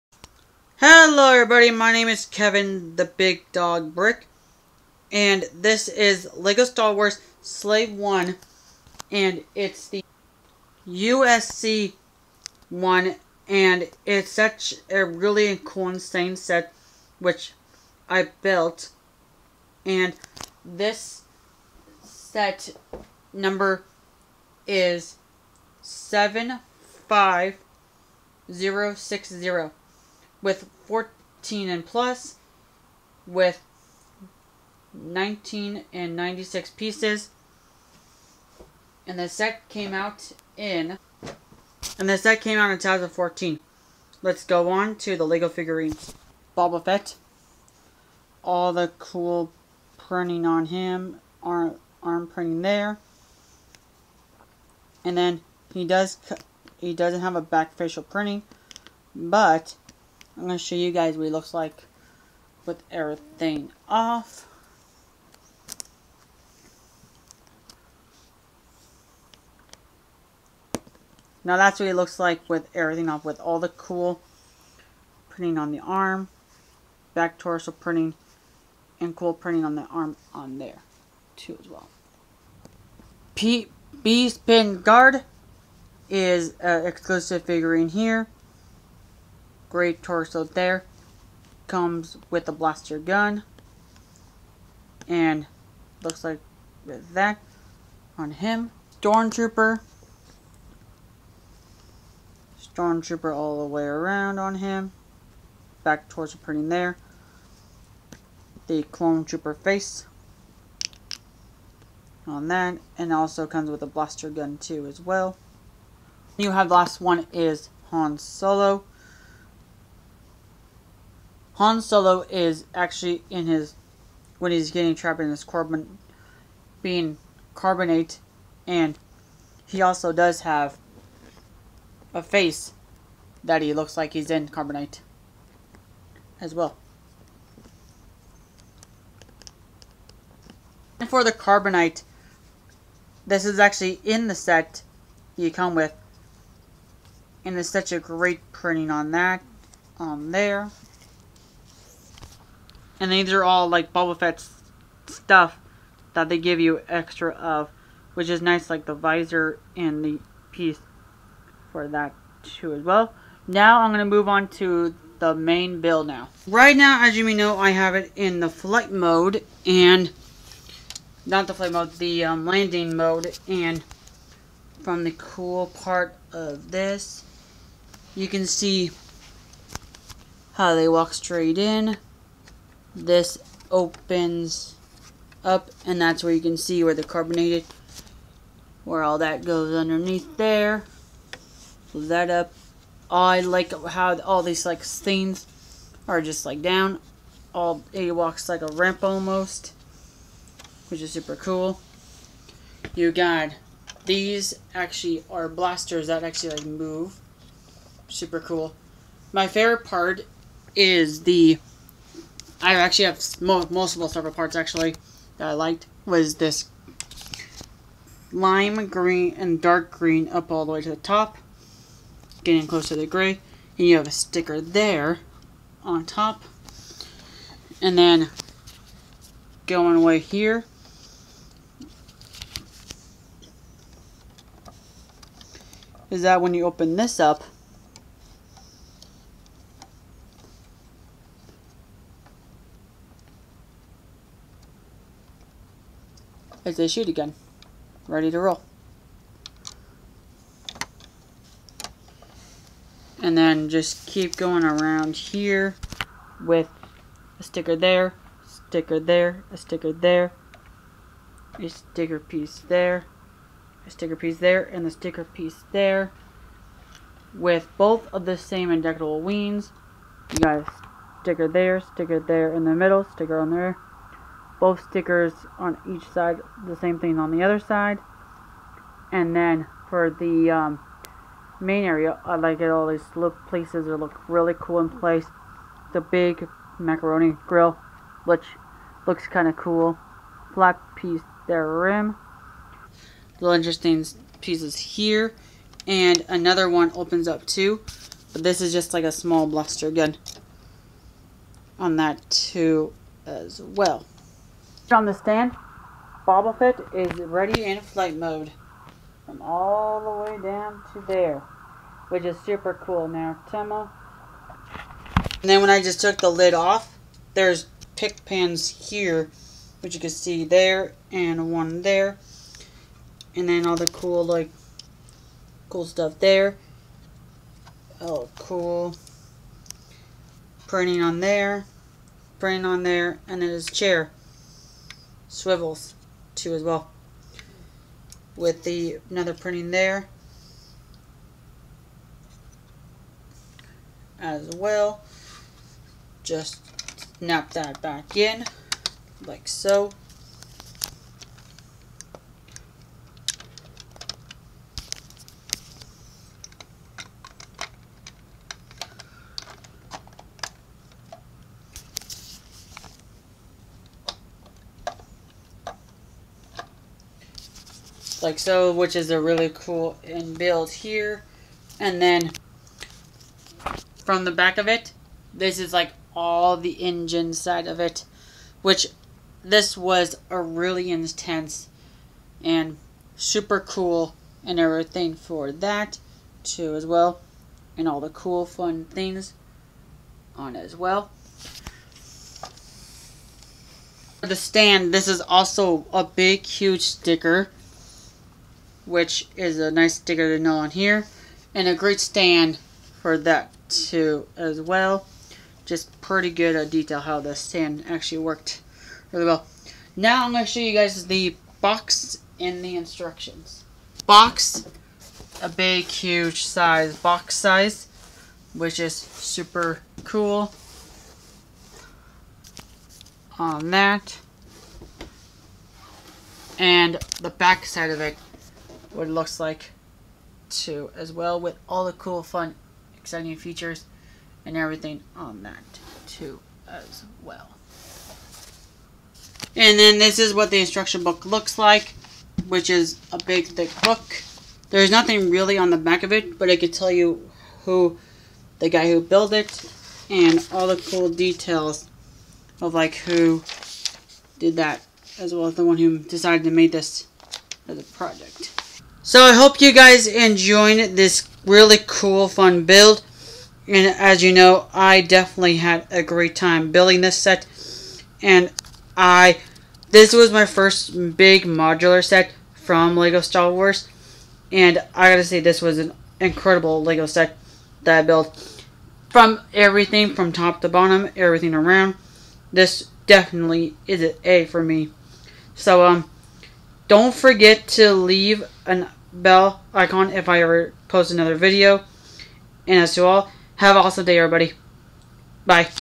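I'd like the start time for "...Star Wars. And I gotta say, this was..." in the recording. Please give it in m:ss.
7:53.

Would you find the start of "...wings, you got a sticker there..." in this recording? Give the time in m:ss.
4:29.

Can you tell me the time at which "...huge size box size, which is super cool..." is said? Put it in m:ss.
6:55.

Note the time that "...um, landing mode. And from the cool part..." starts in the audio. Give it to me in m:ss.
2:52.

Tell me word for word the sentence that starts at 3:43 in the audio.
And you have a sticker there on top.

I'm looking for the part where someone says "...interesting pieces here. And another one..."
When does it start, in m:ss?
4:53.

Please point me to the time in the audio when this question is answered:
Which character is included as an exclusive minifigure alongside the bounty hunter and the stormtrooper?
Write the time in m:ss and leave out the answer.
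1:23.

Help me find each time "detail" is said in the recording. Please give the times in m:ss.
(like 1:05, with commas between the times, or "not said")
6:46, 7:31.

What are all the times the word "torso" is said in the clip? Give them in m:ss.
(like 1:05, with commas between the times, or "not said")
1:17, 1:30.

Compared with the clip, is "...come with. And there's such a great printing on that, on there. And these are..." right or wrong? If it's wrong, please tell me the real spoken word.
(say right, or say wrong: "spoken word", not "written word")
right.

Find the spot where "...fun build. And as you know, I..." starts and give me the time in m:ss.
7:42.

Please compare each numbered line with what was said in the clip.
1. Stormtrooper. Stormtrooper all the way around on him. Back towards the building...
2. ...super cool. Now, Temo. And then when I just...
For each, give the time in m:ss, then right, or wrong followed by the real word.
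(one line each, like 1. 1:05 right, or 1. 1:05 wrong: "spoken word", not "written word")
1. 1:39 wrong: "printing", not "building"
2. 5:12 right.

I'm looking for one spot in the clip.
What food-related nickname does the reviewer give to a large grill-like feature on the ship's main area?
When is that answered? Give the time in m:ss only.
4:46.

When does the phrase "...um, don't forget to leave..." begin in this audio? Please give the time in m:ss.
8:05.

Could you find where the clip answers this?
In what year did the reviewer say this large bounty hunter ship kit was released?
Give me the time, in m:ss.
0:42.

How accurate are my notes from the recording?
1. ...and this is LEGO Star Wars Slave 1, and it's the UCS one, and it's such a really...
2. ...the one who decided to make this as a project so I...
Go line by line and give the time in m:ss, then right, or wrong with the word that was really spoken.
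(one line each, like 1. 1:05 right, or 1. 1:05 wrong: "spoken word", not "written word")
1. 0:05 right
2. 7:35 right.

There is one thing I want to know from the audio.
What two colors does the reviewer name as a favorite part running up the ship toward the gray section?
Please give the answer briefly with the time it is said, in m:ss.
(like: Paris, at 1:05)
lime green and dark green, at 3:38.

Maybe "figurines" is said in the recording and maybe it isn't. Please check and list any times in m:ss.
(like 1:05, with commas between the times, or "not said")
0:45, 1:27.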